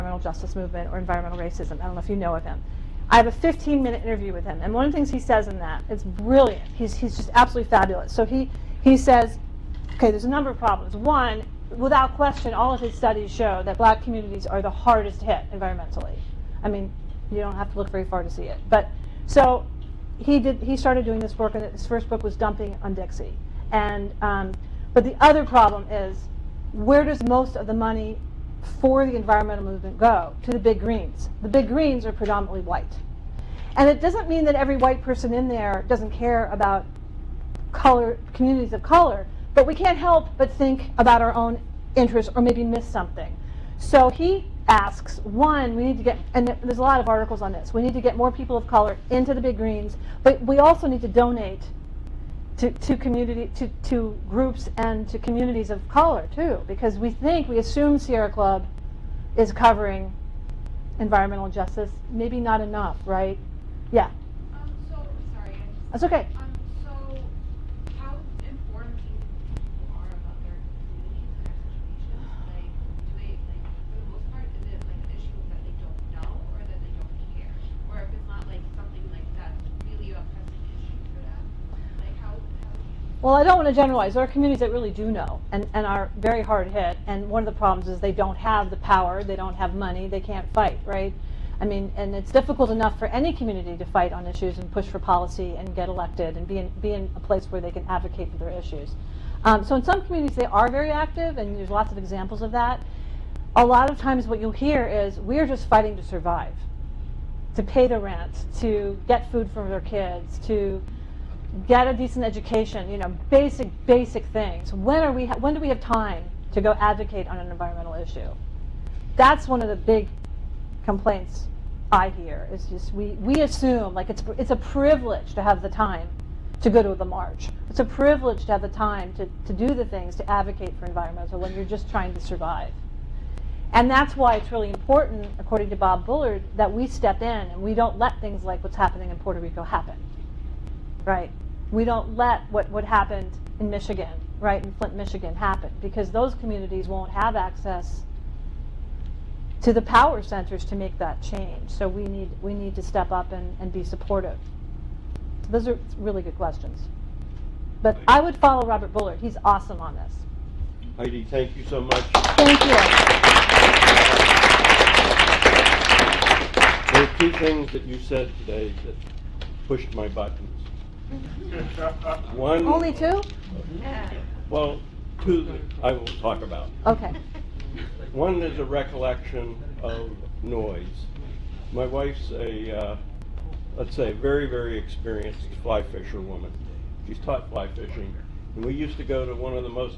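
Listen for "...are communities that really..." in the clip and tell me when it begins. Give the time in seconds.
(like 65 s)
84 s.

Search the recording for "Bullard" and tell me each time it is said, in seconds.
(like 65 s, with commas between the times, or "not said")
136 s, 158 s.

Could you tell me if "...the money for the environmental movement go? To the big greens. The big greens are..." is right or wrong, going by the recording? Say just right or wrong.
right.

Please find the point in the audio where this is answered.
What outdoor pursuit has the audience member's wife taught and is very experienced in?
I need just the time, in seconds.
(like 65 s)
187 s.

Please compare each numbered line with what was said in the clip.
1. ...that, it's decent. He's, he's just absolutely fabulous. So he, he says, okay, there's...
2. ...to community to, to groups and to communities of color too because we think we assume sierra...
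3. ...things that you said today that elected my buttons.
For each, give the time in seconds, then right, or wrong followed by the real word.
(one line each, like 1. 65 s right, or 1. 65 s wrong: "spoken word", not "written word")
1. 5 s wrong: "brilliant", not "decent"
2. 52 s right
3. 167 s wrong: "pushed", not "elected".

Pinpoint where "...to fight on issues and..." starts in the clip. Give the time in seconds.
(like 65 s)
93 s.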